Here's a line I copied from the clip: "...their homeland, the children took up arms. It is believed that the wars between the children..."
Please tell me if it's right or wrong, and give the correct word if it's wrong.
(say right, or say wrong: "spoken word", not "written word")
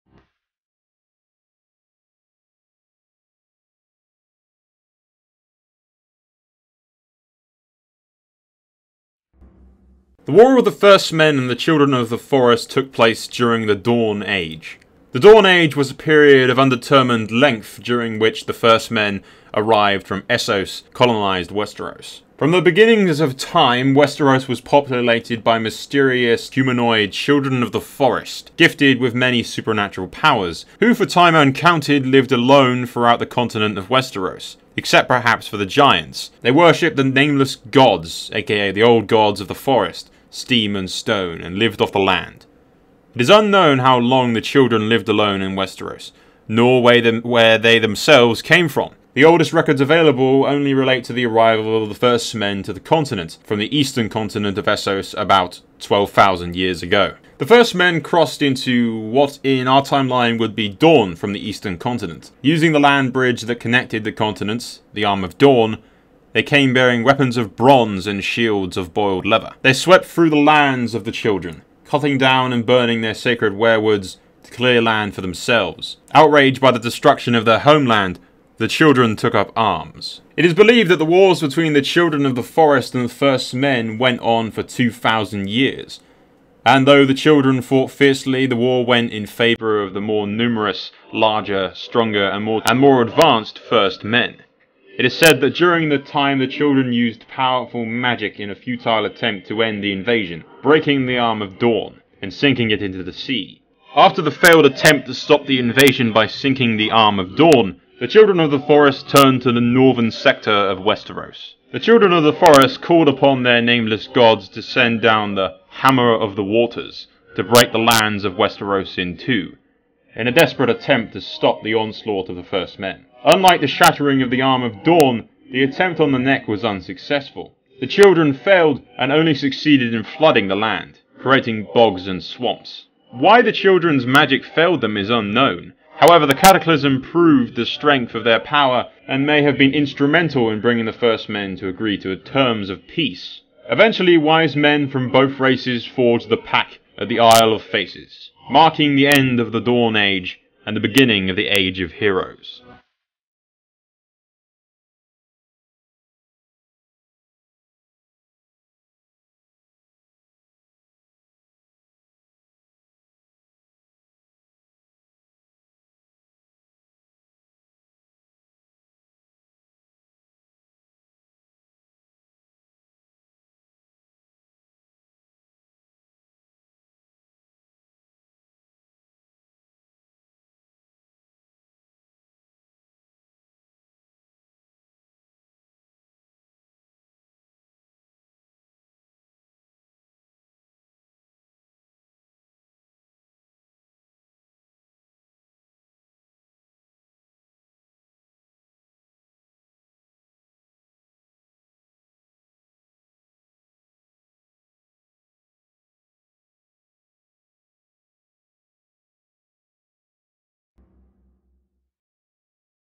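right.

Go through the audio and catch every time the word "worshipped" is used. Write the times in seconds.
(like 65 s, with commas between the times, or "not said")
36 s.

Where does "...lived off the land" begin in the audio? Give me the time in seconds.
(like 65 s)
41 s.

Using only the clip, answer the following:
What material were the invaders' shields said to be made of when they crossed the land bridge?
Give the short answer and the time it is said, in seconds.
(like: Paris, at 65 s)
boiled leather, at 68 s.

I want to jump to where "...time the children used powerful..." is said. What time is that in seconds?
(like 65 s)
95 s.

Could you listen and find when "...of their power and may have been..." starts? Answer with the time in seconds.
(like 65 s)
138 s.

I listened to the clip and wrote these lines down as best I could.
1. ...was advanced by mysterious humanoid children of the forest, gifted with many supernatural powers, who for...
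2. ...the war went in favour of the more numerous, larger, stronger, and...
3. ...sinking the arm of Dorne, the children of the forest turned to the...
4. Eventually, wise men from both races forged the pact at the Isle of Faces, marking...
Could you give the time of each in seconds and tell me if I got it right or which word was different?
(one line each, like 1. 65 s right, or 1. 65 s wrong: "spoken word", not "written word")
1. 24 s wrong: "populated", not "advanced"
2. 88 s right
3. 106 s right
4. 143 s right.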